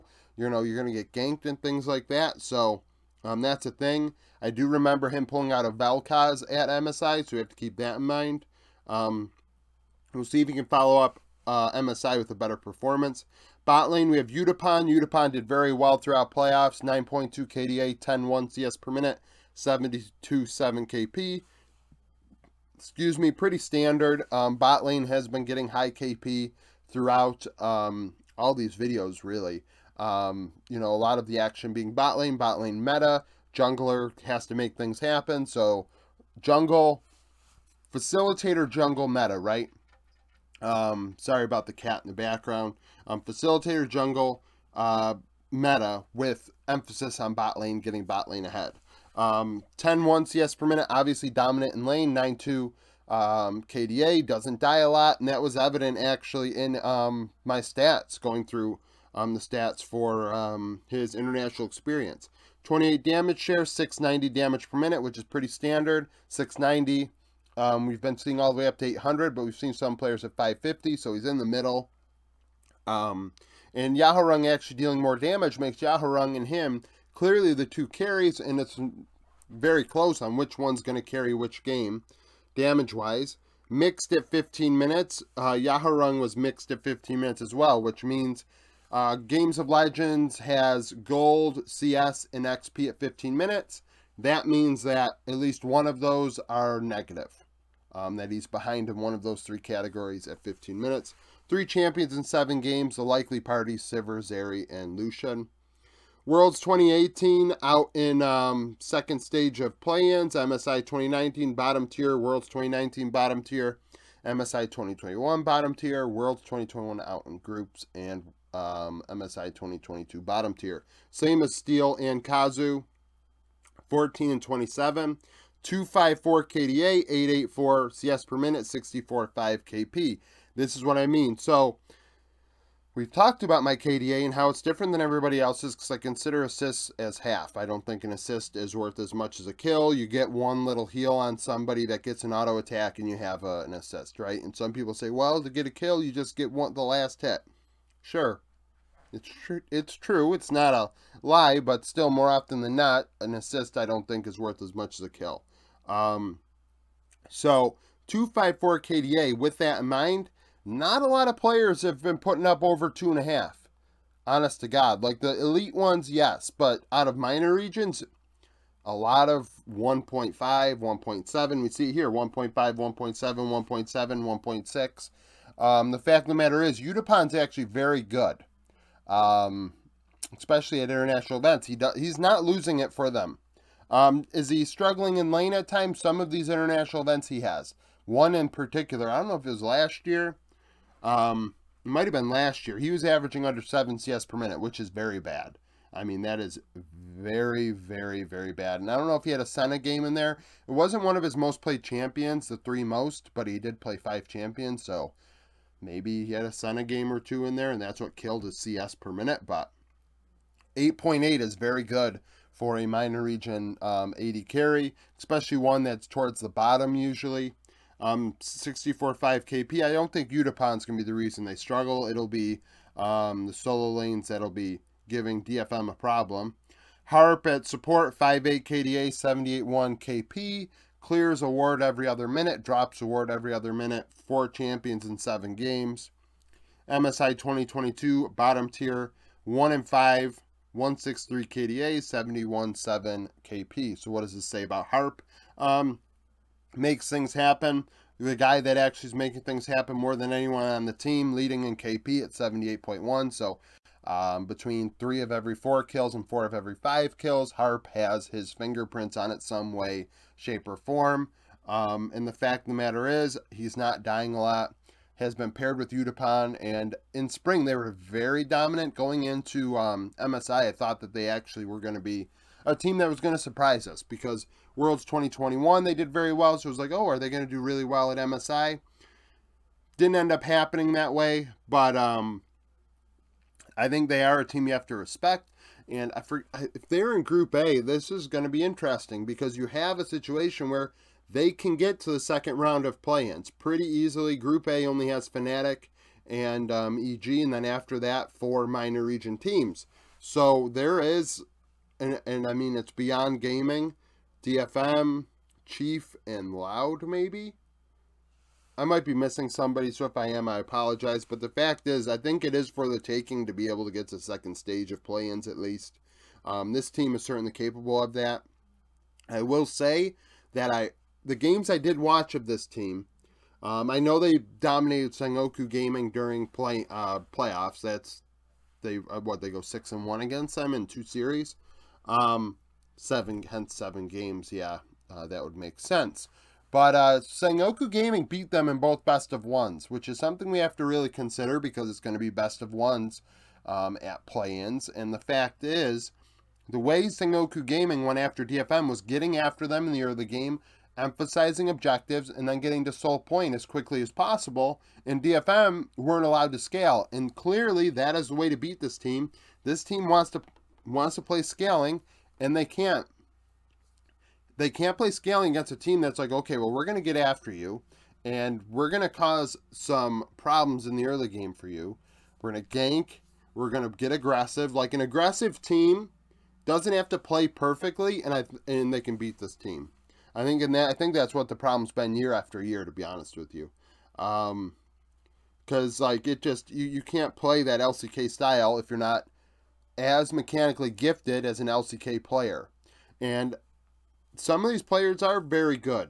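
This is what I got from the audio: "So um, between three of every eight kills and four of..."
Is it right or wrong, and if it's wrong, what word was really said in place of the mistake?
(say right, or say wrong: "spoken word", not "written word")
wrong: "four", not "eight".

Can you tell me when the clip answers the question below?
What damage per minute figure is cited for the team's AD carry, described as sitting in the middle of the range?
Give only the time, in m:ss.
1:03.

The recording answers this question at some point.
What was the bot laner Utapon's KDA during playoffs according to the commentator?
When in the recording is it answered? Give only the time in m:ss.
0:16.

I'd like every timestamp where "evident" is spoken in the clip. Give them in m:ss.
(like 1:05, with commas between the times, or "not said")
0:55.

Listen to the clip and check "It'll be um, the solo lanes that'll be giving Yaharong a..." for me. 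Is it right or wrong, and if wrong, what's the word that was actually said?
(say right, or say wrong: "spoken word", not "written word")
wrong: "DFM", not "Yaharong".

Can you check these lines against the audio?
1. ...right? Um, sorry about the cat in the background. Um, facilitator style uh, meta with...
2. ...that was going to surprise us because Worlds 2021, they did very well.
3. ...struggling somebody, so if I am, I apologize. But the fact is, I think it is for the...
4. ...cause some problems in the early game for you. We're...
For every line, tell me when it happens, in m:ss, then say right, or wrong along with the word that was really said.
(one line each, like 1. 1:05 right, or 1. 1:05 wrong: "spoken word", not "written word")
1. 0:39 wrong: "jungle", not "style"
2. 4:32 right
3. 5:09 wrong: "missing", not "struggling"
4. 6:09 right.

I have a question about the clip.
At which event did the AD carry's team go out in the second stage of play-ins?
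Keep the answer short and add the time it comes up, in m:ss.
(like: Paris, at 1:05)
Worlds 2018, at 1:46.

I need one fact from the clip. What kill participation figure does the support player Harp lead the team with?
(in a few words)
78.1.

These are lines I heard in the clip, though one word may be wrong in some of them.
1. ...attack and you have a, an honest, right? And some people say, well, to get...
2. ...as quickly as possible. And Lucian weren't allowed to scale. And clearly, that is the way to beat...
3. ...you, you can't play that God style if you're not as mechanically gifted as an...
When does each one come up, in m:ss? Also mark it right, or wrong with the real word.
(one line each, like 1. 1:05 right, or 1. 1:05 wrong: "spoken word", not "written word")
1. 2:22 wrong: "assist", not "honest"
2. 5:53 wrong: "DFM", not "Lucian"
3. 6:26 wrong: "LCK", not "God".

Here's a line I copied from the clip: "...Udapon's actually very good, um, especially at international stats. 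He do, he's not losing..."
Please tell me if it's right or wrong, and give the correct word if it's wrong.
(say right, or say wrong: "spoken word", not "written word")
wrong: "events", not "stats".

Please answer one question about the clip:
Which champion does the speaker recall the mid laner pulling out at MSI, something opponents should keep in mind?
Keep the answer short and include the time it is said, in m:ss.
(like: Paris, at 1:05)
Vel'Koz, at 0:05.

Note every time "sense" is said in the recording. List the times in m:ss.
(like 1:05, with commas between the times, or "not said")
5:35.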